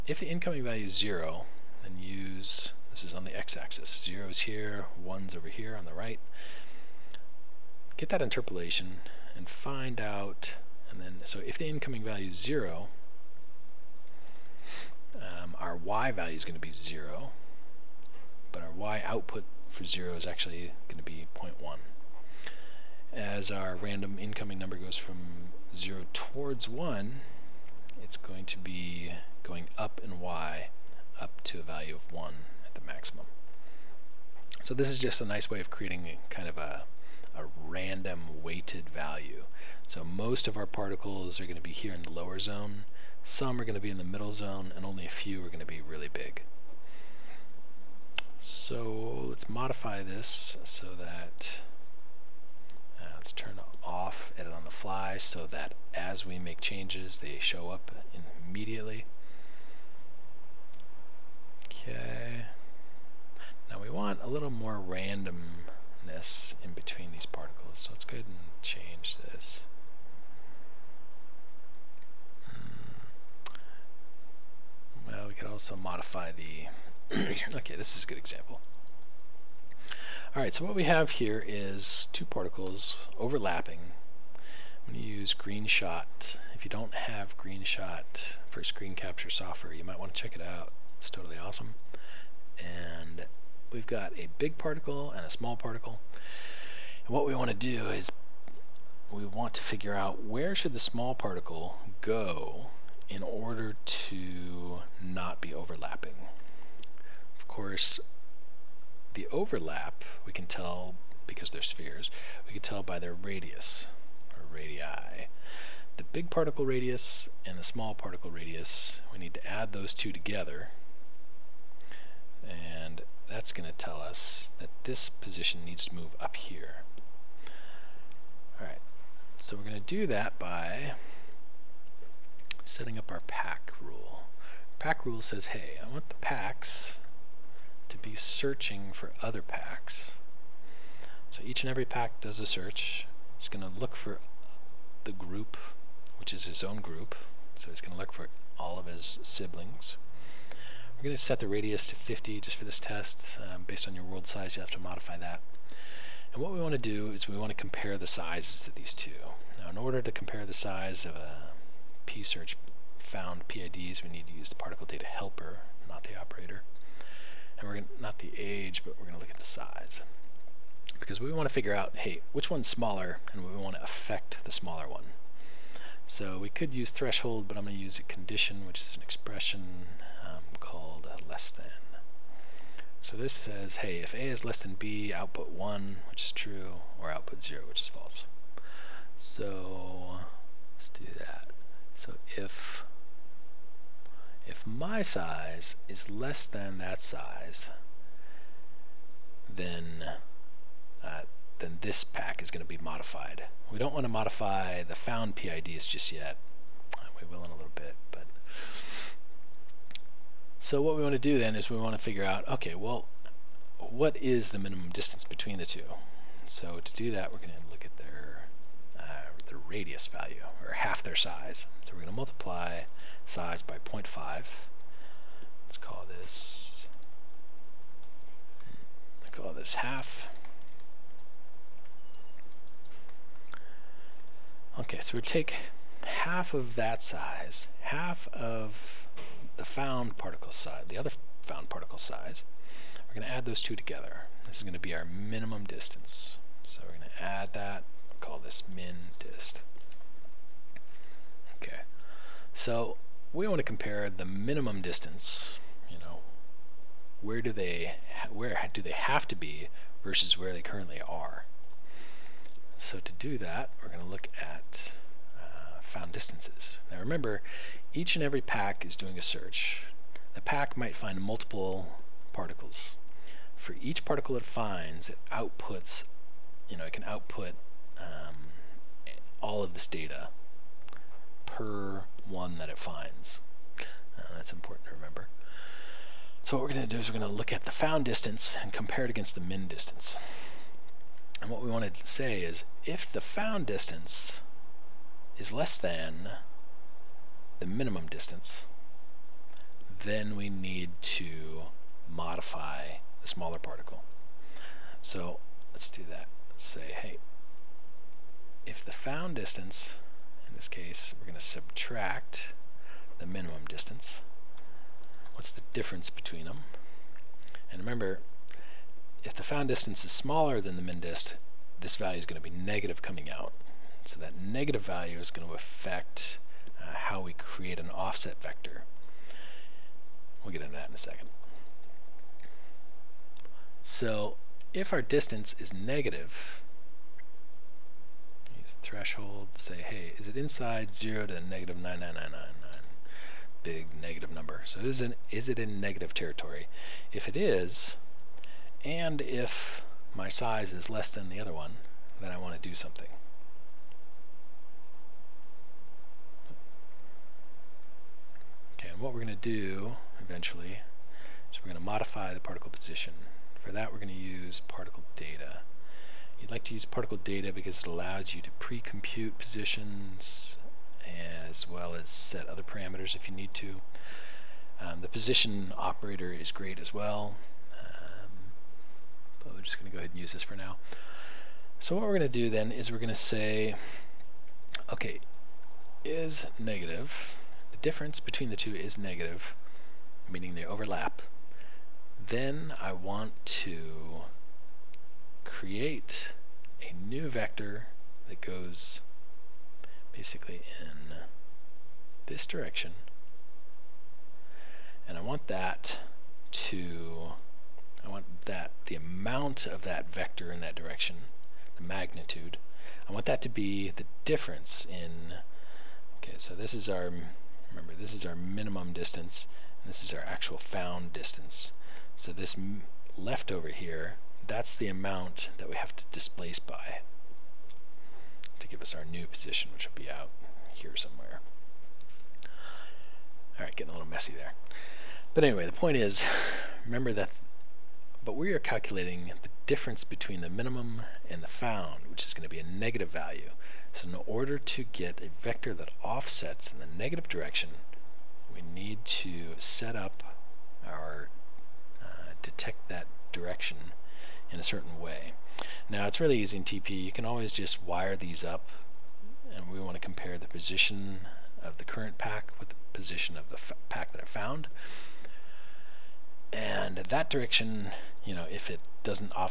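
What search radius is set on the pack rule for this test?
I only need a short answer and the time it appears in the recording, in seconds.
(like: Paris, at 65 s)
50, at 151 s.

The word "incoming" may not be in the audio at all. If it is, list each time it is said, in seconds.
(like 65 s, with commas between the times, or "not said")
0 s, 11 s, 24 s.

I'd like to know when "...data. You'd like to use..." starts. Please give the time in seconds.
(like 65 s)
365 s.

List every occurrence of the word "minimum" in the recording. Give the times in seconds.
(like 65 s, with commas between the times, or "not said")
214 s, 245 s, 254 s, 297 s, 313 s, 418 s, 440 s.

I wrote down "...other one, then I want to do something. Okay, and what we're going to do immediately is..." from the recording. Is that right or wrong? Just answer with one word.
wrong.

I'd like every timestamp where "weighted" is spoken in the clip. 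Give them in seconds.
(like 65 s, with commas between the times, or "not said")
38 s.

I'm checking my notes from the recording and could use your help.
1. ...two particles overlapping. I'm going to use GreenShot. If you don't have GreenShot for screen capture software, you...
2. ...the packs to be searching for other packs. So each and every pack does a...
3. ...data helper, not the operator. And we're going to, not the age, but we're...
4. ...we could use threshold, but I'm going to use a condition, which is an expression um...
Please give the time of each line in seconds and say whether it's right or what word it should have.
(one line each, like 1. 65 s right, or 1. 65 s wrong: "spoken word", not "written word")
1. 82 s right
2. 136 s right
3. 164 s right
4. 176 s right.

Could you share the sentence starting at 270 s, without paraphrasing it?
The pack might find multiple particles.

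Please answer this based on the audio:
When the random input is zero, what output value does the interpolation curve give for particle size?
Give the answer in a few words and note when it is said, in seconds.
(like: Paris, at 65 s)
0.1, at 21 s.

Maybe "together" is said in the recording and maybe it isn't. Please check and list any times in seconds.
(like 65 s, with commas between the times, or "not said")
120 s, 243 s.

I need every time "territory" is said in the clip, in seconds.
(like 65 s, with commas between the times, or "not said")
346 s.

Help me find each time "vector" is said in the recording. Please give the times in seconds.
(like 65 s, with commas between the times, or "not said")
328 s, 397 s, 410 s, 445 s.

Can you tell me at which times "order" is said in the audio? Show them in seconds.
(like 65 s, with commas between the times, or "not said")
103 s, 159 s, 444 s.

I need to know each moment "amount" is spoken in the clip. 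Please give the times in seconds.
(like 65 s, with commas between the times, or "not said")
408 s, 424 s.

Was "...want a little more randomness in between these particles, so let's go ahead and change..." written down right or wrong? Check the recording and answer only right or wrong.
right.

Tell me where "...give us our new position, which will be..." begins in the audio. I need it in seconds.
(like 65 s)
428 s.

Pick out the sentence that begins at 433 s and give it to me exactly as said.
Alright, getting a little messy there.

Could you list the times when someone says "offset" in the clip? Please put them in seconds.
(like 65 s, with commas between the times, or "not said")
327 s, 446 s.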